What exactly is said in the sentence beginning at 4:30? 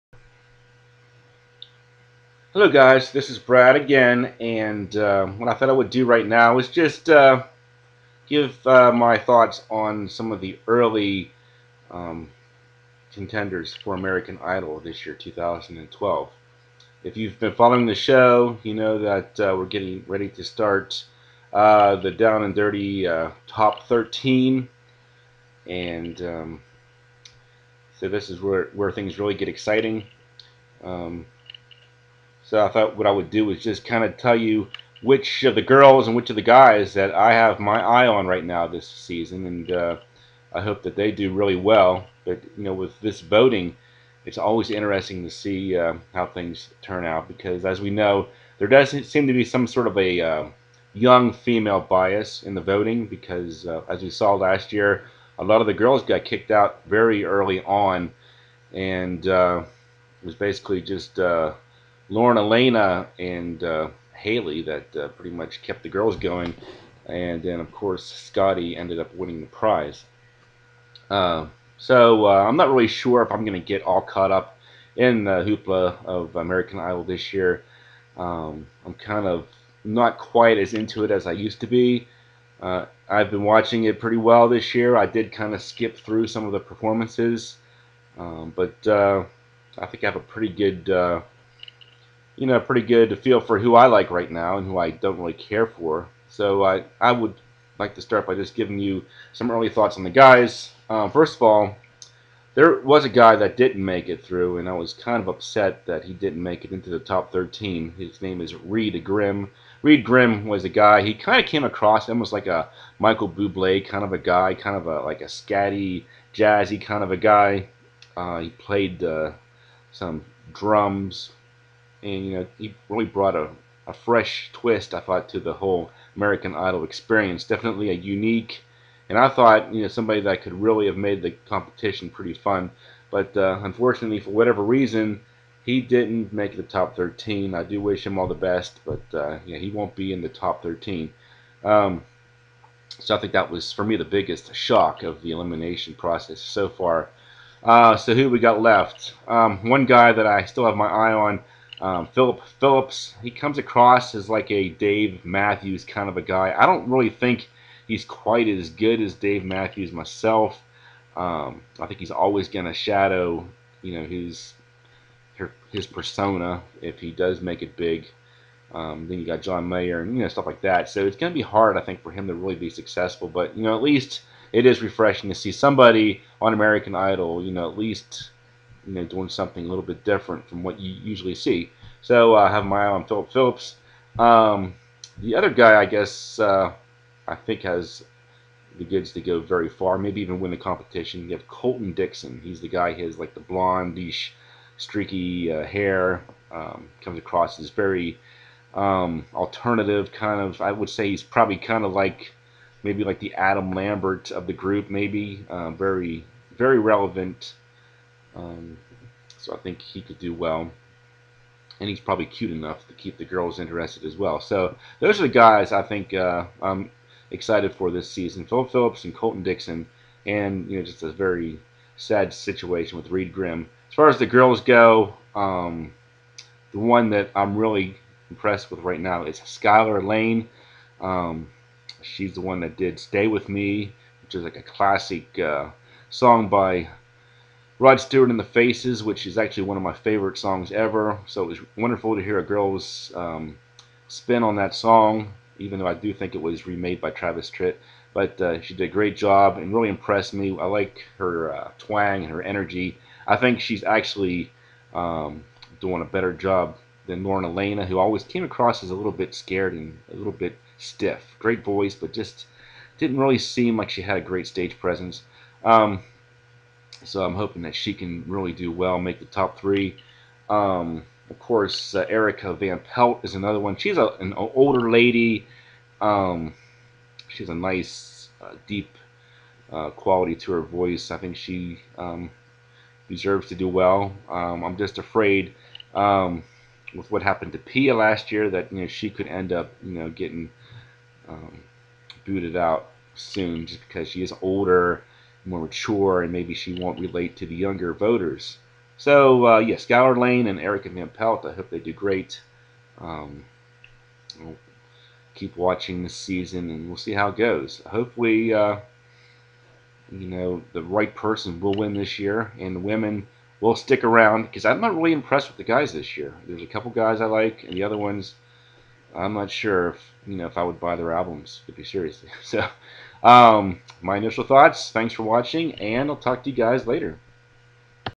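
Um, of course, uh, Erika Van Pelt is another one.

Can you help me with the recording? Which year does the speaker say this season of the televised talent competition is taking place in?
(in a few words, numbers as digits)
2012.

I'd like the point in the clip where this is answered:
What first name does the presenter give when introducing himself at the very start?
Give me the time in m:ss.
0:03.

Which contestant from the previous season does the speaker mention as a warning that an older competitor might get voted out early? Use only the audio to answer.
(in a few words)
Pia.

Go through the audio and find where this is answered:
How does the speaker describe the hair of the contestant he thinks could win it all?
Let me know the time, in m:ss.
3:13.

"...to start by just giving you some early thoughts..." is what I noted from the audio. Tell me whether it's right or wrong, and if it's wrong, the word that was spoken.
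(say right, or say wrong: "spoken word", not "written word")
right.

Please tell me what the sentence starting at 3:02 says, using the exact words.
So uh, I have my eye on Phillip Phillips.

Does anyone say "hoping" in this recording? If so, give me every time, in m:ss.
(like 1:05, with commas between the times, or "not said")
4:27.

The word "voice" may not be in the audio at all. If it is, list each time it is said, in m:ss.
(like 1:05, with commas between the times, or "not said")
4:21, 4:40.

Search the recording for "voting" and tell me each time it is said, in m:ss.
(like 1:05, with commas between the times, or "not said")
0:43, 0:52.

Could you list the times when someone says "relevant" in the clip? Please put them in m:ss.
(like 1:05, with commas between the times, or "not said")
3:26.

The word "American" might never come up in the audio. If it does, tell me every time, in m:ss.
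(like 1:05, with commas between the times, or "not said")
0:13, 1:16, 2:06, 2:56.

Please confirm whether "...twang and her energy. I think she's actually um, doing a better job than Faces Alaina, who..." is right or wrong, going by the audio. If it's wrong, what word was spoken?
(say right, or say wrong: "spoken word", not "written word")
wrong: "Lauren", not "Faces".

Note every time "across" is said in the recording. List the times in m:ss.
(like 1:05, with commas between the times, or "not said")
1:51, 2:33, 3:17, 4:18.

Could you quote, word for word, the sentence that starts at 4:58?
So, uh, yes, Gower Lane and Erika Van Pelt, I hope they do great.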